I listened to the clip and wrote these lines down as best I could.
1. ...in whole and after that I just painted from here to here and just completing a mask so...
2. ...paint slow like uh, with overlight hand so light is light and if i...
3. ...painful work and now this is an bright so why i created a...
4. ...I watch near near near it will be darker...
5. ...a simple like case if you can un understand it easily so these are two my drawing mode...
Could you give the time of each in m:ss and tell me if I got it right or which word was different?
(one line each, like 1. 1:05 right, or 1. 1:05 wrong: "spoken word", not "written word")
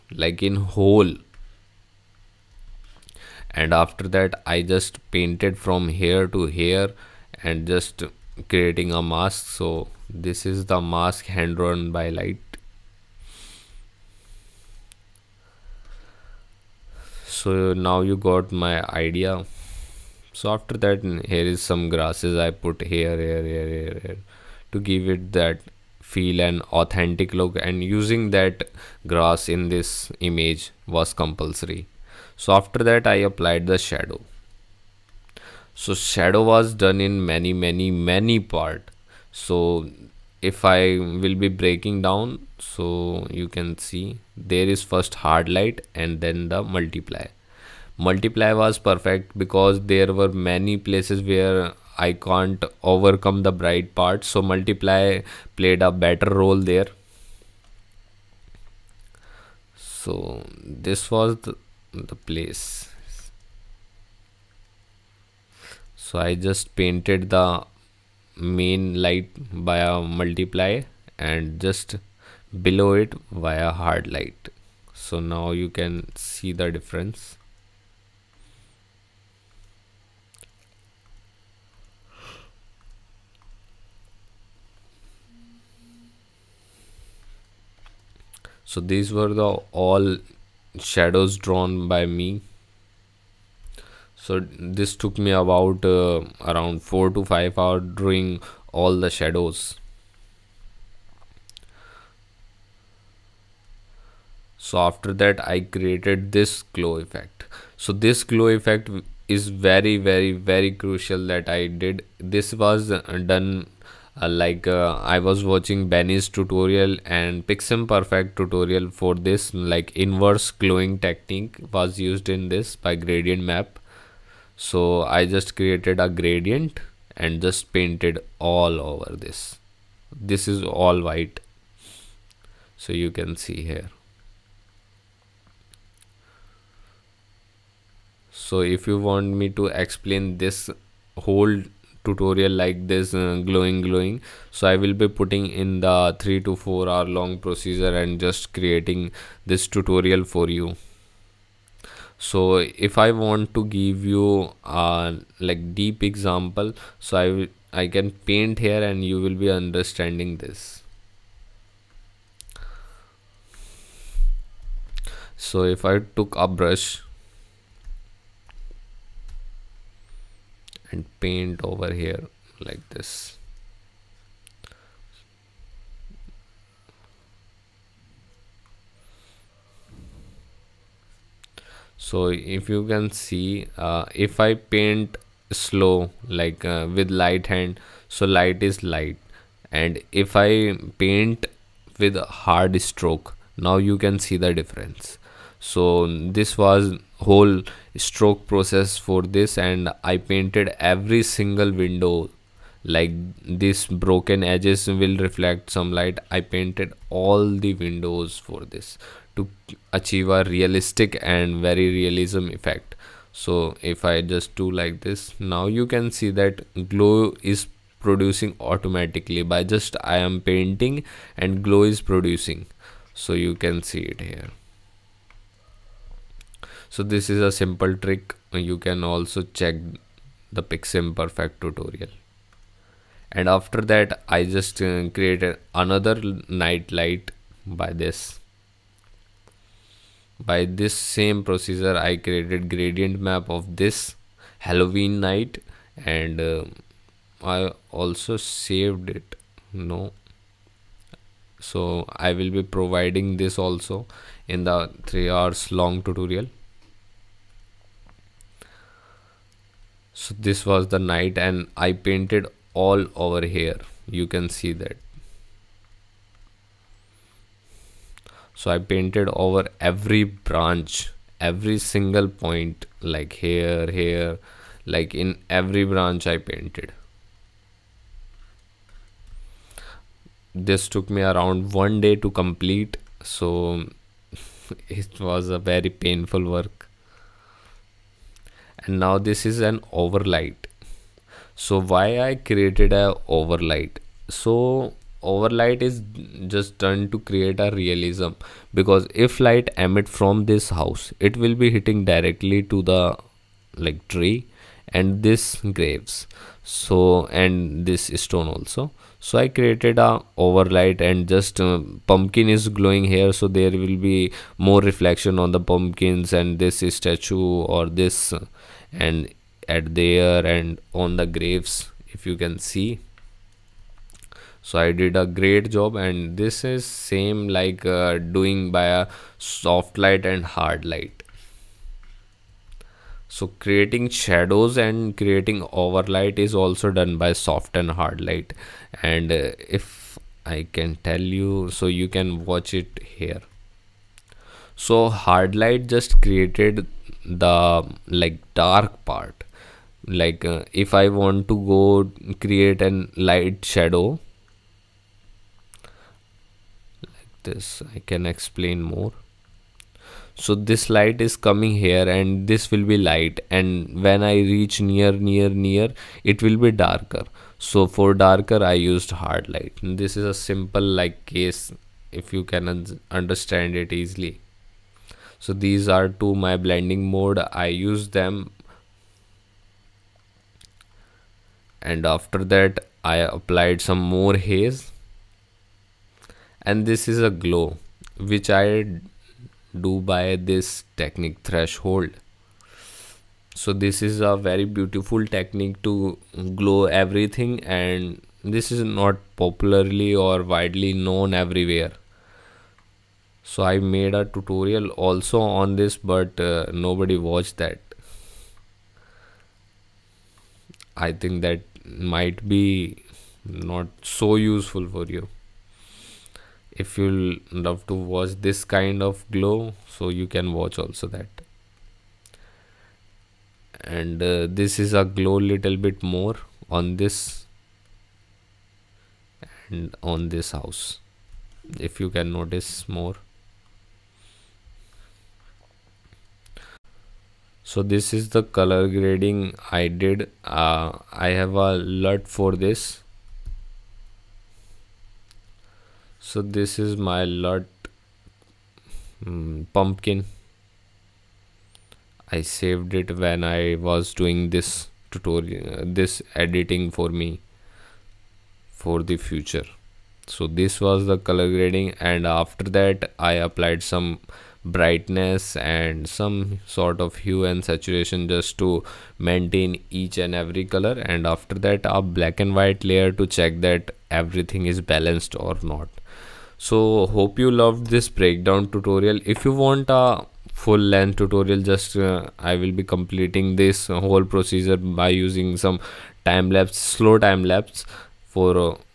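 1. 0:00 wrong: "creating", not "completing"
2. 3:04 wrong: "light", not "overlight"
3. 4:45 wrong: "overlight", not "bright"
4. 6:04 wrong: "reach", not "watch"
5. 6:10 wrong: "blending", not "drawing".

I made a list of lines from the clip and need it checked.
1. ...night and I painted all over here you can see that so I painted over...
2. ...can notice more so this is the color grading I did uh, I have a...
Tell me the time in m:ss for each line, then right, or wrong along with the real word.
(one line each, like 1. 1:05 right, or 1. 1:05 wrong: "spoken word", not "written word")
1. 4:20 right
2. 7:12 right.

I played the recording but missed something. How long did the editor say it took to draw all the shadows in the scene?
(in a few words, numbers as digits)
4 to 5 hours.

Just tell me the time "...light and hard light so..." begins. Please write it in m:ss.
5:29.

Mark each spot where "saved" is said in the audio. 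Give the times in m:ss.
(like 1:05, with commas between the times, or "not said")
4:08, 7:32.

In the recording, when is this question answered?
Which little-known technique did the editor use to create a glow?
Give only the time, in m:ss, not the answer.
6:31.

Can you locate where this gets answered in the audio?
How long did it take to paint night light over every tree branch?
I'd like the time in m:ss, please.
4:41.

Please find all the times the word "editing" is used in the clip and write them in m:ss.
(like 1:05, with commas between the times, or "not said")
7:36.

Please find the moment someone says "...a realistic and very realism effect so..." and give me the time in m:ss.
3:30.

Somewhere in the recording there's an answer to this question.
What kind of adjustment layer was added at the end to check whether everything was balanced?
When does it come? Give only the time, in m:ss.
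7:51.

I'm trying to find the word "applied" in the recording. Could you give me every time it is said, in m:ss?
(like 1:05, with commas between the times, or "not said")
0:33, 6:23, 7:43.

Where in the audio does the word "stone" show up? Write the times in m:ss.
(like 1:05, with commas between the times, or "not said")
5:08.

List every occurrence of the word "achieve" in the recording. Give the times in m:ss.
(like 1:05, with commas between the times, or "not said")
3:29.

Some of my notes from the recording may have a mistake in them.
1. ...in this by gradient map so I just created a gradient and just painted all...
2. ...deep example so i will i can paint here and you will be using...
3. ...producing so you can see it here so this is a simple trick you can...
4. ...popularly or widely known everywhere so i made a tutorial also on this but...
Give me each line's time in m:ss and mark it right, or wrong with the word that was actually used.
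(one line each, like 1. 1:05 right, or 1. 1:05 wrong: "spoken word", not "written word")
1. 2:02 right
2. 2:35 wrong: "understanding", not "using"
3. 3:42 right
4. 6:39 right.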